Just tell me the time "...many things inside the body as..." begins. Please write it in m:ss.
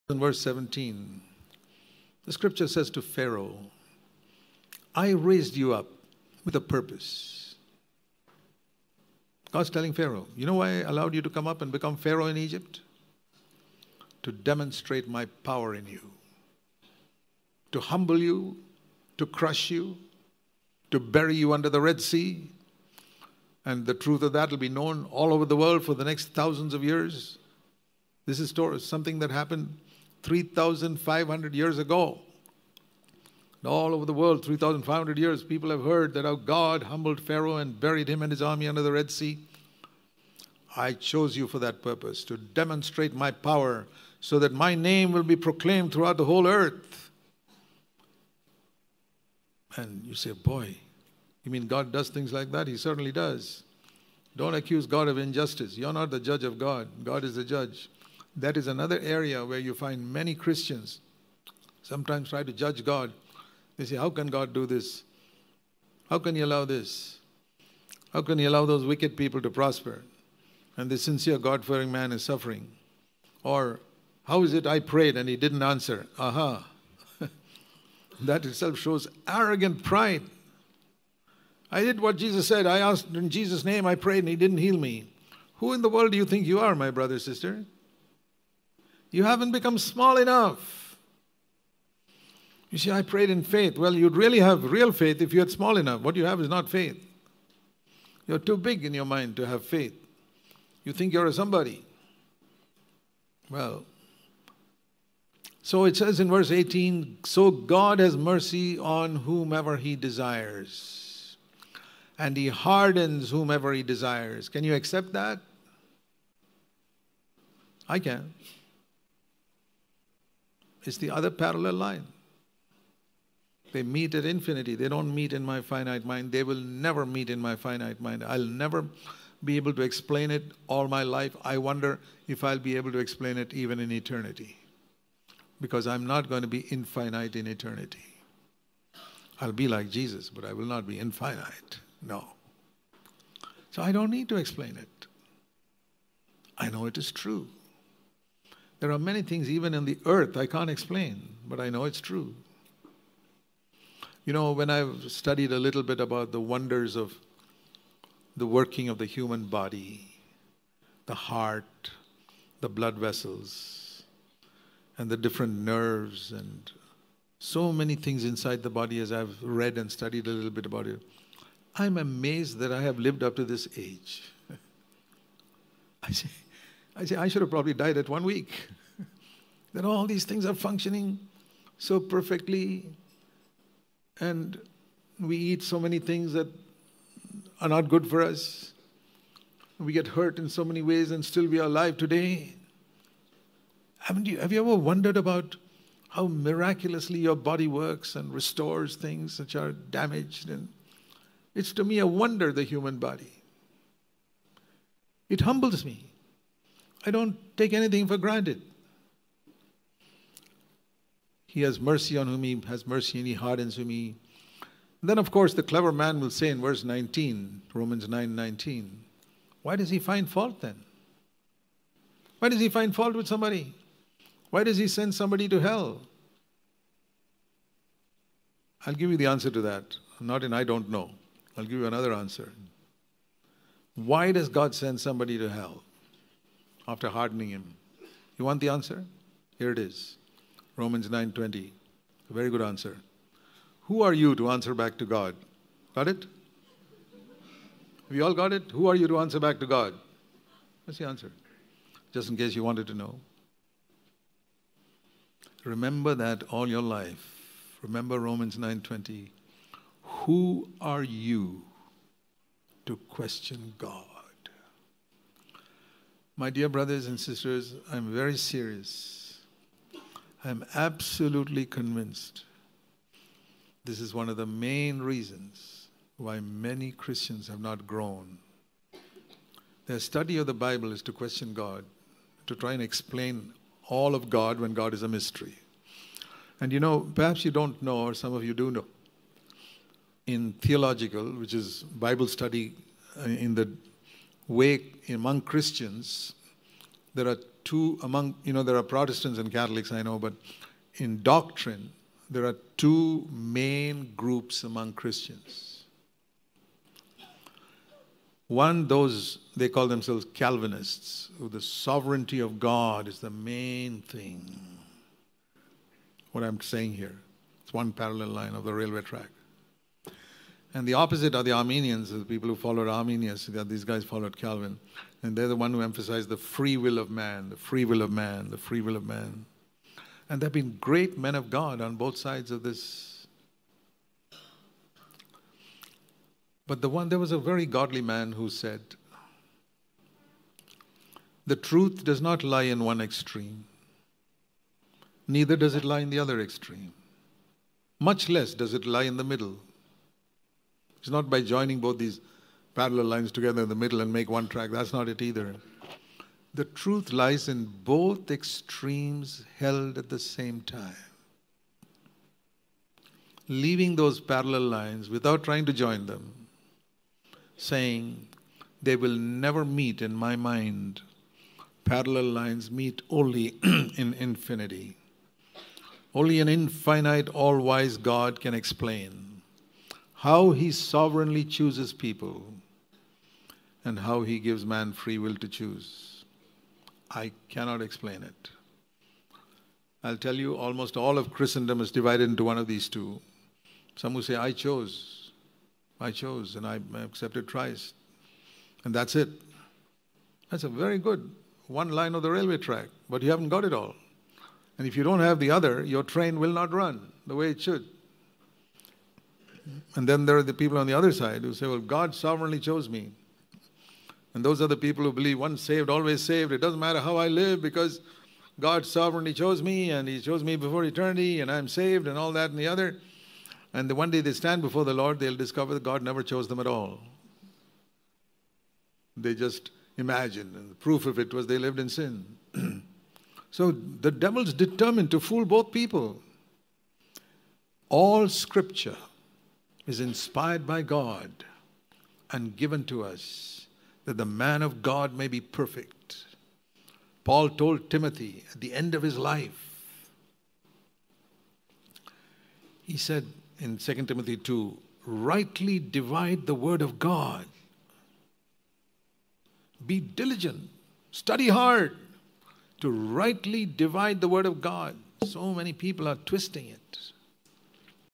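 2:47.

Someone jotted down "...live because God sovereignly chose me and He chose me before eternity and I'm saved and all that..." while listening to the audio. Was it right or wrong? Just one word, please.
right.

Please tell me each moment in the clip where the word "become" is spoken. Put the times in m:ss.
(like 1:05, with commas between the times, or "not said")
0:11, 1:29.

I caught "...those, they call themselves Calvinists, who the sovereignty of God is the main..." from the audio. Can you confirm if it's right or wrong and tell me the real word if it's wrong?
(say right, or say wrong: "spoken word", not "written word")
right.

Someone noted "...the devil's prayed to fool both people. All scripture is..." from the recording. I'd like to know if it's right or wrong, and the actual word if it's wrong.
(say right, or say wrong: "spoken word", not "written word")
wrong: "determined", not "prayed".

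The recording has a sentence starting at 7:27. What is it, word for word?
Paul told Timothy at the end of his life, he said in 2 Timothy 2, rightly divide the word of God.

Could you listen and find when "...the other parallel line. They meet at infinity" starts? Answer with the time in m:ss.
2:00.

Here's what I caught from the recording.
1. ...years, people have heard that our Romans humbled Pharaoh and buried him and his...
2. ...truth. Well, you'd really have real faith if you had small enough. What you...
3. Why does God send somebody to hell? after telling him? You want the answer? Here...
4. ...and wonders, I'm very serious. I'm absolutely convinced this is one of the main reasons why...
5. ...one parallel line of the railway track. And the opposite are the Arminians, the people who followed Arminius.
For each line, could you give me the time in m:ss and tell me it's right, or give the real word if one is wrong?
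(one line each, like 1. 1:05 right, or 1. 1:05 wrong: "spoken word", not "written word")
1. 0:35 wrong: "God", not "Romans"
2. 1:33 wrong: "faith", not "truth"
3. 3:53 wrong: "hardening", not "telling"
4. 4:27 wrong: "sisters", not "wonders"
5. 5:17 right.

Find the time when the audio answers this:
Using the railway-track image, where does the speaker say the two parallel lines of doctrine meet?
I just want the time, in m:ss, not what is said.
6:13.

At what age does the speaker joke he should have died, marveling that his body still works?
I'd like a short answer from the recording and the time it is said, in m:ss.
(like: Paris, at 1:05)
at one week, at 2:57.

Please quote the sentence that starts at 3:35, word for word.
Then, of course, the clever man will say in verse 19, Romans 9 19, why does he find fault then?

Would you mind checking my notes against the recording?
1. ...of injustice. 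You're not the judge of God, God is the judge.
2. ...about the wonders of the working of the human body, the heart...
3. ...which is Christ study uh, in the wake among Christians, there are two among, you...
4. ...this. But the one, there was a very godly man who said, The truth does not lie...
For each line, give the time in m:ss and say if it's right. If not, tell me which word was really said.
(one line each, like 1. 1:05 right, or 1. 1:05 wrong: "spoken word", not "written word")
1. 0:55 right
2. 2:35 right
3. 4:51 wrong: "Bible", not "Christ"
4. 5:32 right.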